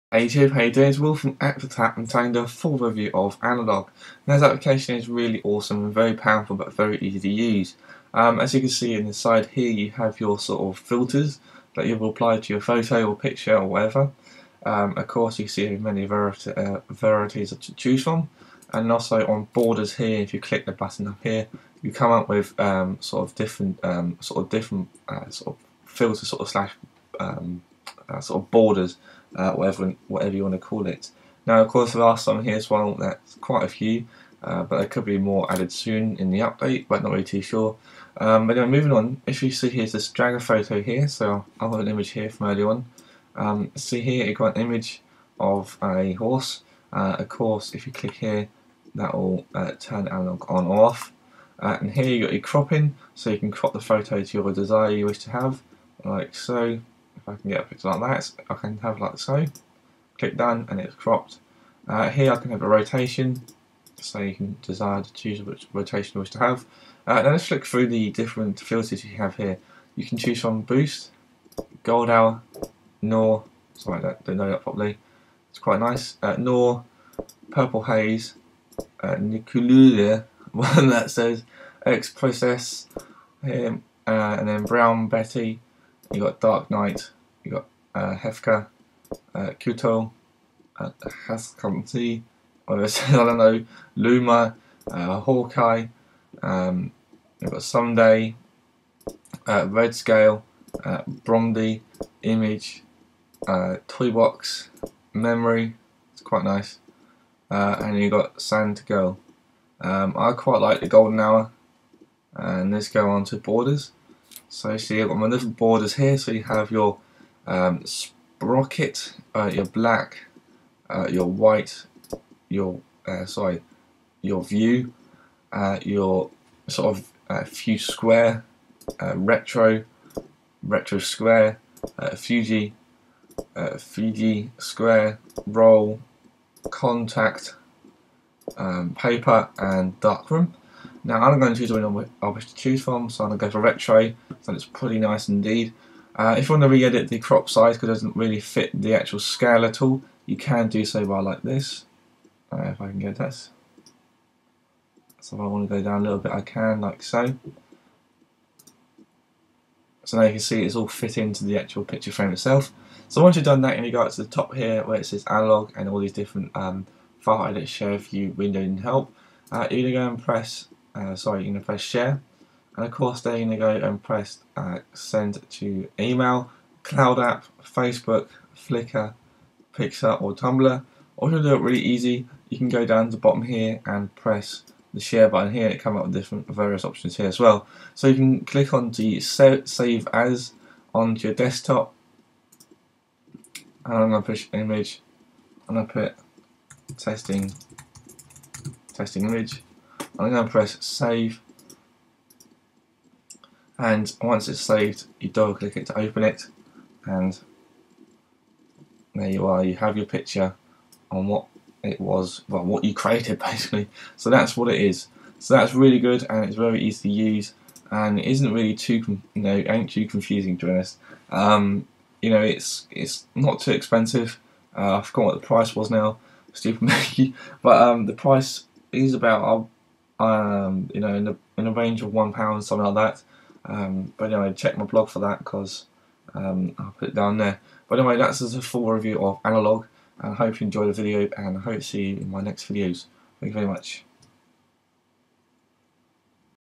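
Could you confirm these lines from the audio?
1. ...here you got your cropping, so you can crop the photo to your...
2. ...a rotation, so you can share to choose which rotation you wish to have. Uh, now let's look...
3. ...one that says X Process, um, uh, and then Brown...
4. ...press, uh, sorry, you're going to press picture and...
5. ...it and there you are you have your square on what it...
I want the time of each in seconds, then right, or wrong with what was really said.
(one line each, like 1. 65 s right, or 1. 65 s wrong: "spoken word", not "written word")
1. 51 s right
2. 62 s wrong: "desire", not "share"
3. 80 s right
4. 170 s wrong: "share", not "picture"
5. 206 s wrong: "picture", not "square".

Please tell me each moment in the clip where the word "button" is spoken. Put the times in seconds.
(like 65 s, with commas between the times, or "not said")
20 s, 185 s.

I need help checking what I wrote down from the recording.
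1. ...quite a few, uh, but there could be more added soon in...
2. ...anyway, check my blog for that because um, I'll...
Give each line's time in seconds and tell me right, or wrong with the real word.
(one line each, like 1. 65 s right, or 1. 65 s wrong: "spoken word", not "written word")
1. 33 s right
2. 234 s right.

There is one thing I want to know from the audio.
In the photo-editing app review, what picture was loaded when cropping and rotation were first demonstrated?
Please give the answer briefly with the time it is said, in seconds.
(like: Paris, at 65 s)
A horse, at 44 s.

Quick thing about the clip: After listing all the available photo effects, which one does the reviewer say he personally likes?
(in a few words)
Golden Hour.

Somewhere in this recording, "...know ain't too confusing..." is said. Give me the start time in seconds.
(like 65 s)
219 s.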